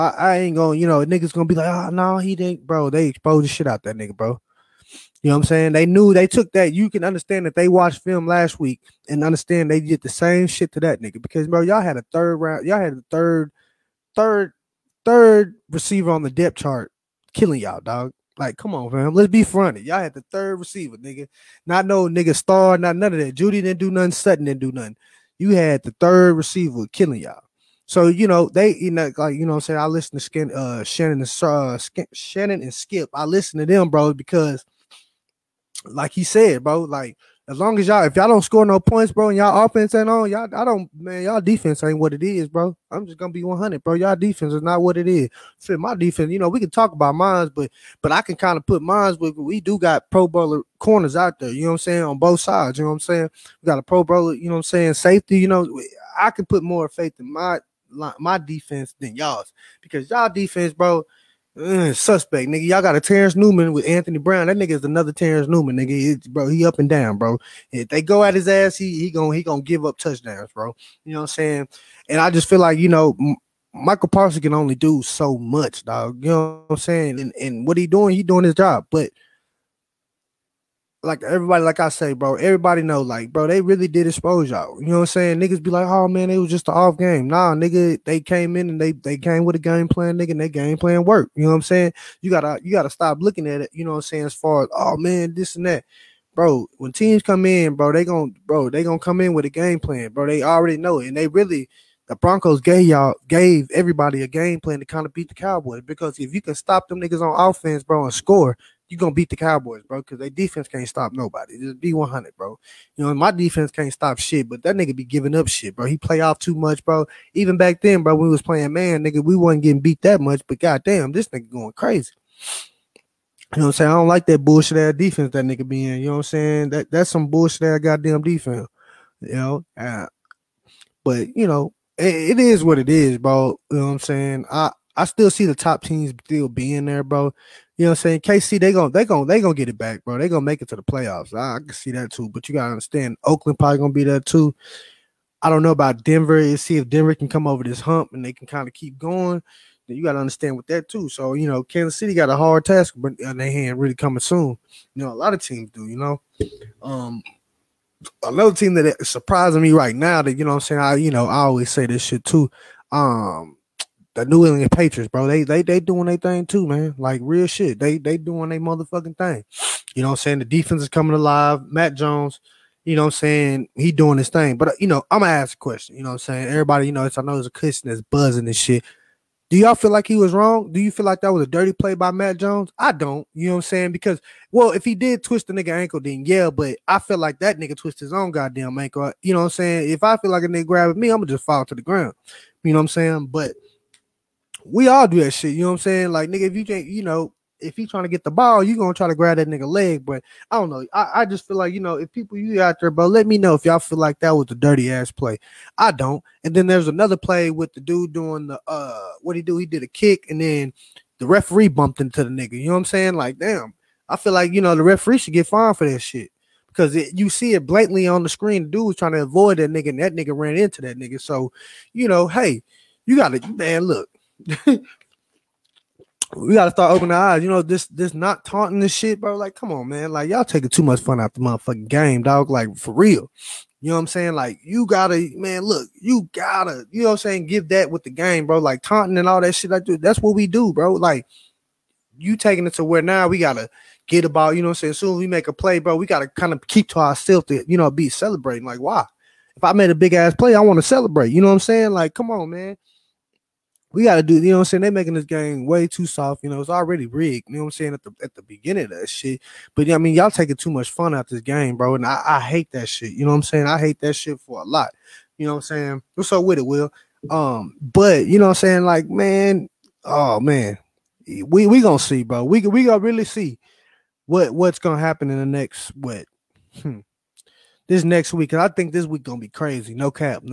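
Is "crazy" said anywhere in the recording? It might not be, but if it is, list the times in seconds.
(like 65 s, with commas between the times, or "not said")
121 s, 279 s.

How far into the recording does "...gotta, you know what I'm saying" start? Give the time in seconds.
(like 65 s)
236 s.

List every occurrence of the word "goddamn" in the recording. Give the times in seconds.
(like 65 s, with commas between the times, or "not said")
120 s, 127 s, 188 s.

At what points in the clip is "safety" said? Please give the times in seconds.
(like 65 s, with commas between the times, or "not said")
54 s.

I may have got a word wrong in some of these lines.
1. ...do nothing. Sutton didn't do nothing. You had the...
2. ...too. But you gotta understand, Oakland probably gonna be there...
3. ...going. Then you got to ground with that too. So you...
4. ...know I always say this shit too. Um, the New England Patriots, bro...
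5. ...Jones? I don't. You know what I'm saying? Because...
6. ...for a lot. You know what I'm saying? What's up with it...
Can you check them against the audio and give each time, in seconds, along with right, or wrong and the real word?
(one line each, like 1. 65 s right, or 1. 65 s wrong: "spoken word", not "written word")
1. 23 s right
2. 142 s right
3. 148 s wrong: "understand", not "ground"
4. 161 s right
5. 182 s right
6. 264 s right.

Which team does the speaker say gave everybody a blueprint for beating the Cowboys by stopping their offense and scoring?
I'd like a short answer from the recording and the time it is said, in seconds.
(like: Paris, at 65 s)
Broncos, at 102 s.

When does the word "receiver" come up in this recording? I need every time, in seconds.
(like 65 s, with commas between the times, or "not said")
15 s, 20 s, 26 s.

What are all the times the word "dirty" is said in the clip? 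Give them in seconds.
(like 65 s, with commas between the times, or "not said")
181 s, 204 s.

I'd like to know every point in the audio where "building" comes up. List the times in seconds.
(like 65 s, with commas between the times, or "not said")
not said.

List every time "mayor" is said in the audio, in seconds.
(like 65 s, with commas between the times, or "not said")
not said.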